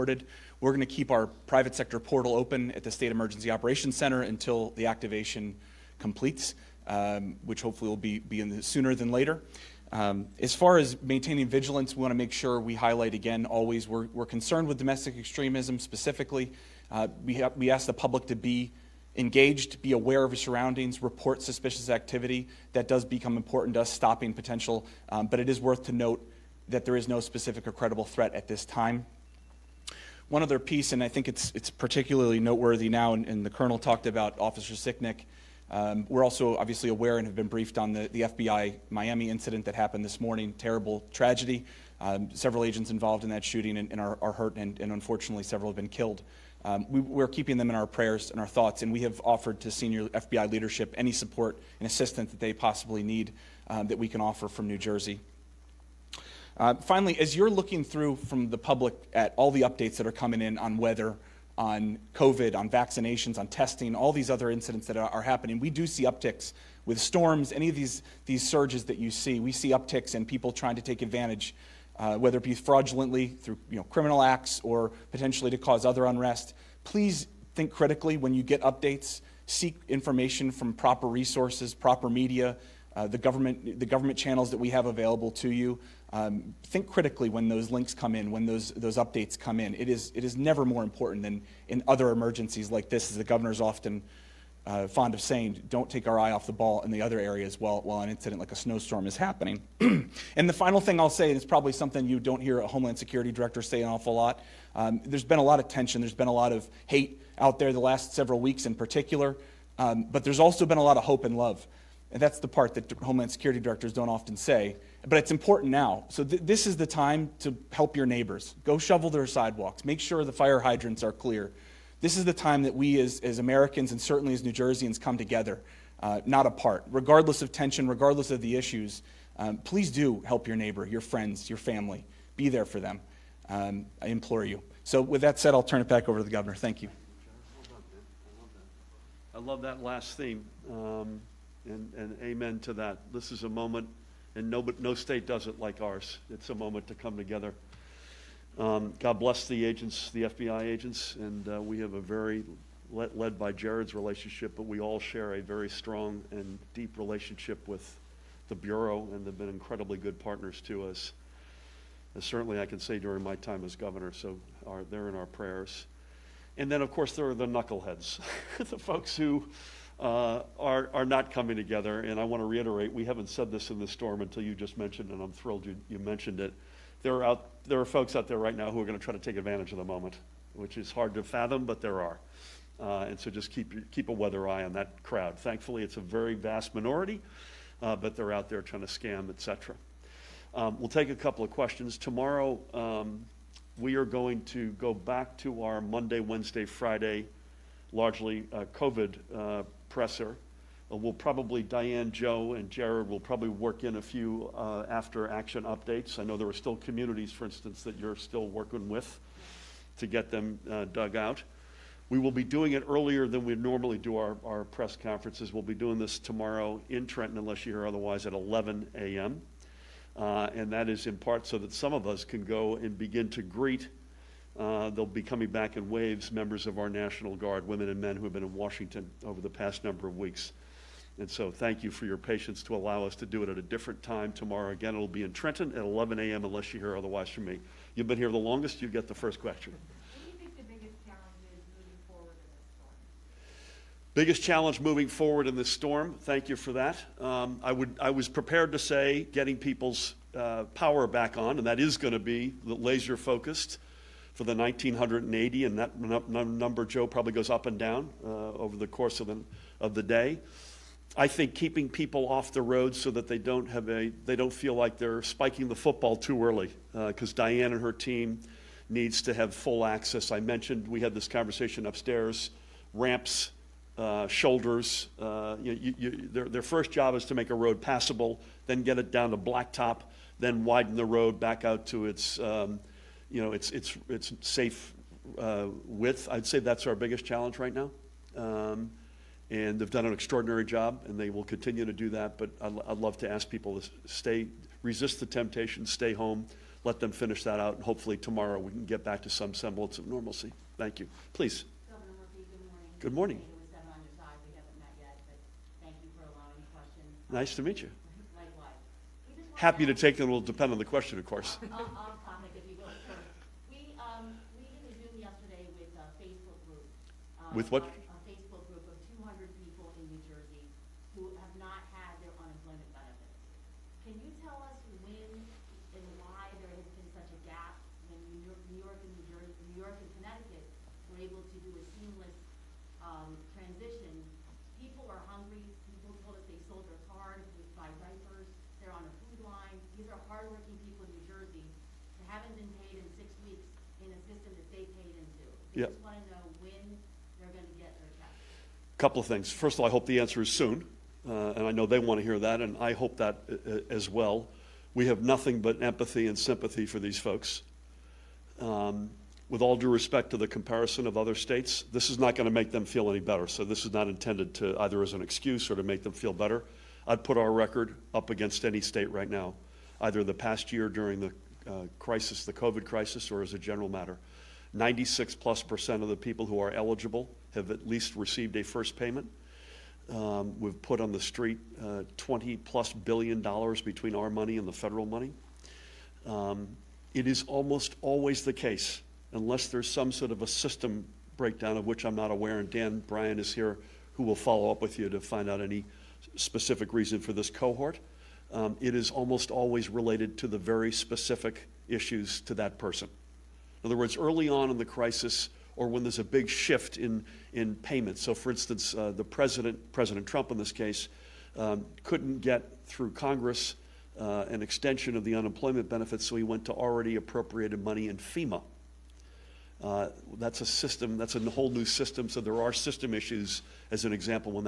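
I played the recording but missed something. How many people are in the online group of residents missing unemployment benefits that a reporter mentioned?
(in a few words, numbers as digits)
200.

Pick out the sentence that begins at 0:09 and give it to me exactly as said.
Um, as far as maintaining vigilance, we want to make sure we highlight again always we're, we're concerned with domestic extremism specifically.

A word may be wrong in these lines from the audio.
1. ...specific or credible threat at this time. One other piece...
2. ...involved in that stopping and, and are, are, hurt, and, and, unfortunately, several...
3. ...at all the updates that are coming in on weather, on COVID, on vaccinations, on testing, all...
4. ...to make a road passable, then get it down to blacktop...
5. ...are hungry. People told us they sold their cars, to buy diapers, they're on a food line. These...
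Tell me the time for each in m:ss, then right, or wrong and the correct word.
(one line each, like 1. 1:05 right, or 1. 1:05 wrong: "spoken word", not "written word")
1. 0:27 right
2. 0:42 wrong: "shooting", not "stopping"
3. 0:59 right
4. 4:37 right
5. 5:35 right.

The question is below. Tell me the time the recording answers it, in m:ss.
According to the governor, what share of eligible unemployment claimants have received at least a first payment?
6:14.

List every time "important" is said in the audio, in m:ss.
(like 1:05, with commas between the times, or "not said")
0:23, 1:30, 1:55.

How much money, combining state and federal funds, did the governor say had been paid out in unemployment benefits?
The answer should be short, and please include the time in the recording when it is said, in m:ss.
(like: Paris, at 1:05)
20 plus billion dollars, at 6:22.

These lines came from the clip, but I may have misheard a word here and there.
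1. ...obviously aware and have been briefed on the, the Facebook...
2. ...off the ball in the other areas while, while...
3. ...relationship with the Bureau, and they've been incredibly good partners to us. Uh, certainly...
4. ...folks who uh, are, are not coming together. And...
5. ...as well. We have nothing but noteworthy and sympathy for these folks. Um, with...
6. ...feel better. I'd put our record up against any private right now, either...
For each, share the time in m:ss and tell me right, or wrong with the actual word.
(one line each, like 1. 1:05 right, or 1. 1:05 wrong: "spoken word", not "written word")
1. 0:36 wrong: "FBI", not "Facebook"
2. 1:36 right
3. 2:36 right
4. 2:48 right
5. 5:53 wrong: "empathy", not "noteworthy"
6. 6:06 wrong: "state", not "private".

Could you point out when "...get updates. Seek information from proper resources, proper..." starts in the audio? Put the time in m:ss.
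1:18.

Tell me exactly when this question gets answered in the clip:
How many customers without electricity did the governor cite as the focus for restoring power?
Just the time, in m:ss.
4:14.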